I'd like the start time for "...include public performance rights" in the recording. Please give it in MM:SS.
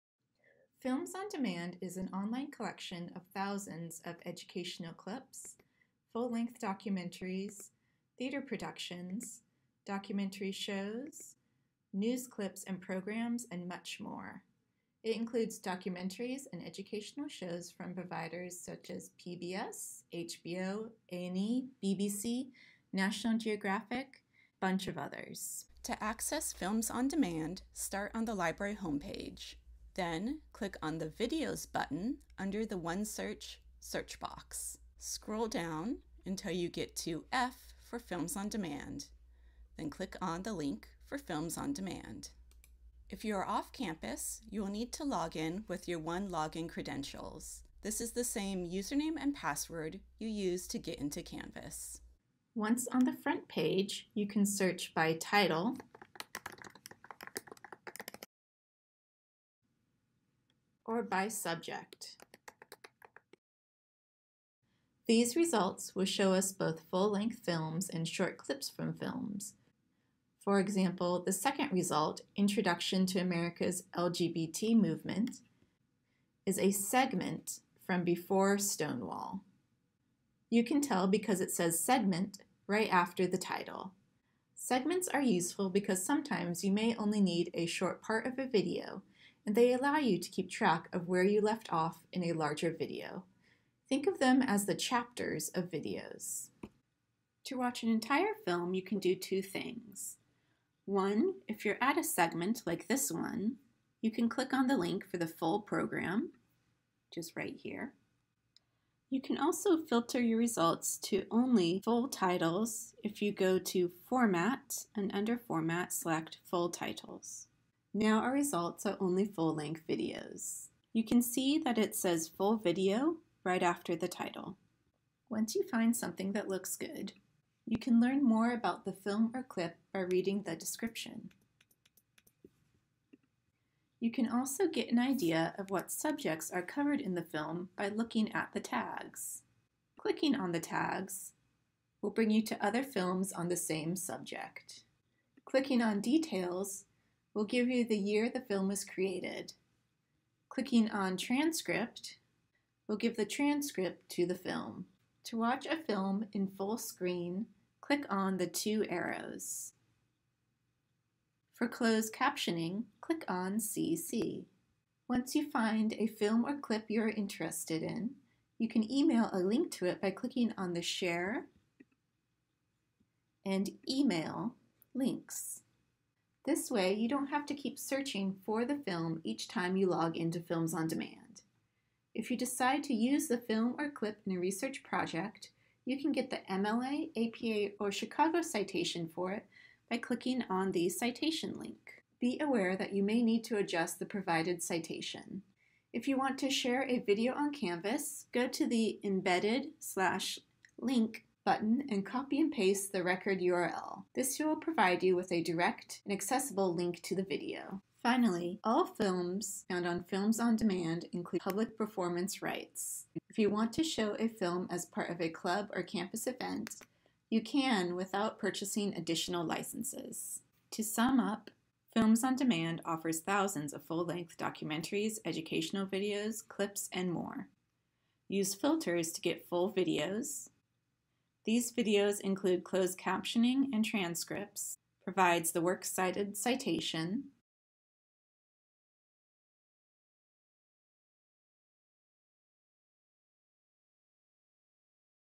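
03:31.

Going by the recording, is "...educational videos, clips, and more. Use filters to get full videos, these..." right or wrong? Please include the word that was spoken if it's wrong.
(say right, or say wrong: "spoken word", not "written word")
right.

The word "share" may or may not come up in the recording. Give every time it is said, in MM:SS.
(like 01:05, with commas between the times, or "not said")
02:50, 03:16.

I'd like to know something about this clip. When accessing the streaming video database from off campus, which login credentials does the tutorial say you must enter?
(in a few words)
OneLogin.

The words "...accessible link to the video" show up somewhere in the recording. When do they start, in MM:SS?
03:26.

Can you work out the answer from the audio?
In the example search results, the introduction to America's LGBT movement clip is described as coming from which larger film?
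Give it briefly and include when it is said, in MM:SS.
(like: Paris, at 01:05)
Before Stonewall, at 01:18.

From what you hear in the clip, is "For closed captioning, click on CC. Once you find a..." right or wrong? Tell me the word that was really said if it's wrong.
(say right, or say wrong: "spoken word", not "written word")
right.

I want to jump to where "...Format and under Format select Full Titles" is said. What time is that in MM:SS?
01:54.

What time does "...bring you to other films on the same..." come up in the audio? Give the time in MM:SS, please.
02:22.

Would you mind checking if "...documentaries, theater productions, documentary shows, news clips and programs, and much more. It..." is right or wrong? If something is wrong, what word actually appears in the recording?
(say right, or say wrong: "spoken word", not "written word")
right.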